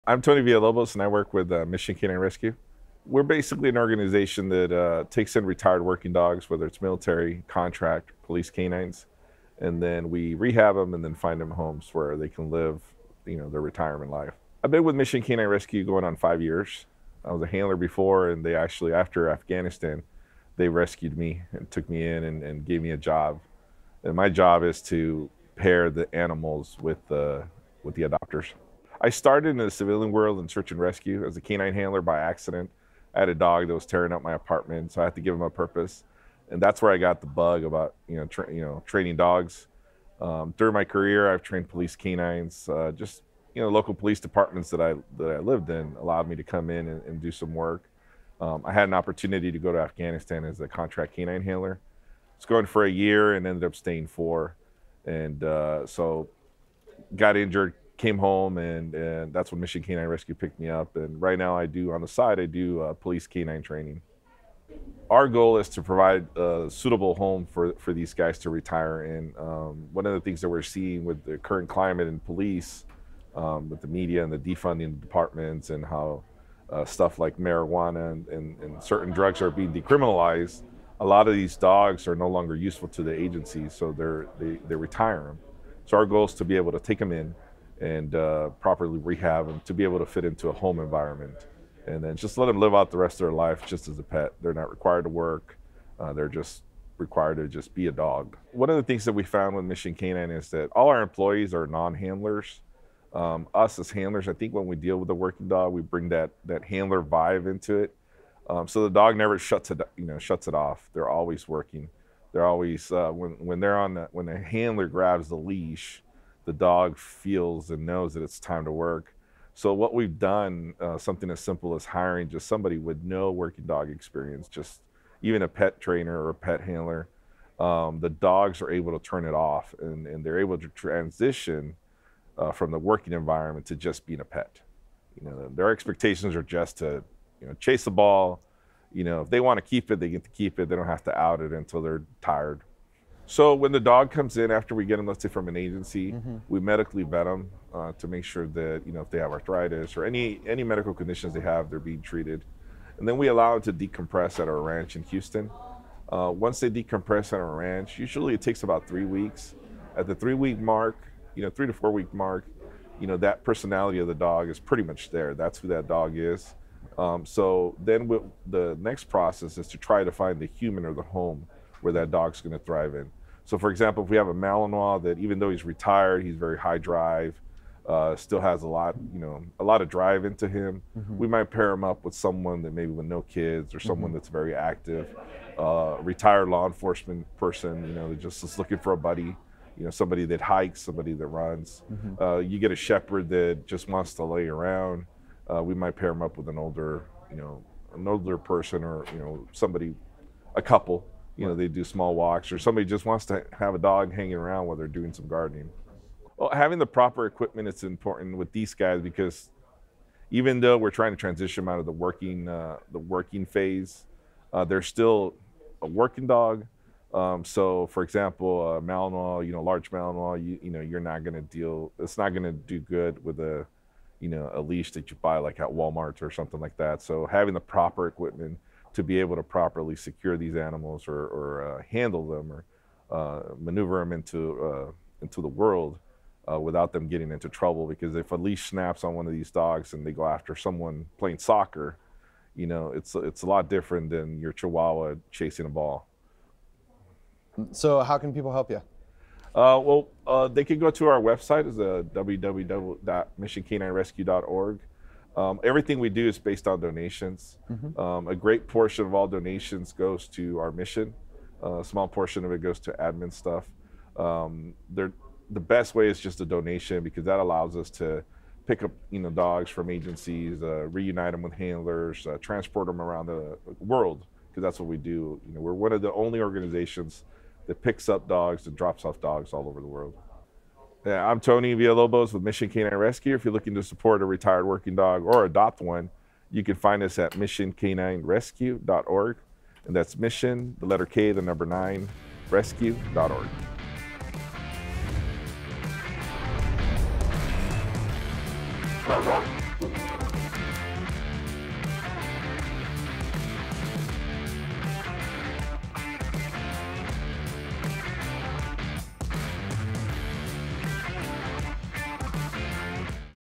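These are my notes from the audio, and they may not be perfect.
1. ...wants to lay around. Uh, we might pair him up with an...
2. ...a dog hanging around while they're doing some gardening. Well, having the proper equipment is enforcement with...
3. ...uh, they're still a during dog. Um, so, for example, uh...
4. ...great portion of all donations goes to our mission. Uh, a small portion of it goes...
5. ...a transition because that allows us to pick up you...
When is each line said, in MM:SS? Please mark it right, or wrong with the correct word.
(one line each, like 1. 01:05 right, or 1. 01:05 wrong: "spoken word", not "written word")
1. 03:13 right
2. 03:23 wrong: "important", not "enforcement"
3. 03:34 wrong: "working", not "during"
4. 04:18 right
5. 04:26 wrong: "donation", not "transition".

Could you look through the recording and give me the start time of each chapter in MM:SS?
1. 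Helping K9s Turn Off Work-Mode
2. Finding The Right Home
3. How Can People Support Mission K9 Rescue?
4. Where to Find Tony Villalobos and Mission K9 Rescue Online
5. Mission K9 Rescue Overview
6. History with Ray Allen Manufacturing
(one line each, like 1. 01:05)
1. 01:39
2. 02:49
3. 04:07
4. 04:41
5. 01:05
6. 03:38.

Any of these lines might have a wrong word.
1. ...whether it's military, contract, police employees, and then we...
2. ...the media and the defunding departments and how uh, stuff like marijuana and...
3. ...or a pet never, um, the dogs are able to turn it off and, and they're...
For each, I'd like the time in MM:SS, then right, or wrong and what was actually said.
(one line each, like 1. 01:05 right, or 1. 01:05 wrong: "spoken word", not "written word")
1. 00:06 wrong: "canines", not "employees"
2. 01:13 right
3. 02:06 wrong: "handler", not "never".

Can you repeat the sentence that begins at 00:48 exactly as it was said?
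Um, I had an opportunity to go to Afghanistan as a contract canine handler.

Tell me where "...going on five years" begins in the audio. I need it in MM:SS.
00:15.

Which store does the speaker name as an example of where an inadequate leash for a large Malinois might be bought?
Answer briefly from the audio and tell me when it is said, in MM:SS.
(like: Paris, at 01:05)
Walmart, at 03:45.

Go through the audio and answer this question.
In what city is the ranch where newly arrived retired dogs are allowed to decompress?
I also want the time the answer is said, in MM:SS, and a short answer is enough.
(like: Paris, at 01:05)
Houston, at 02:35.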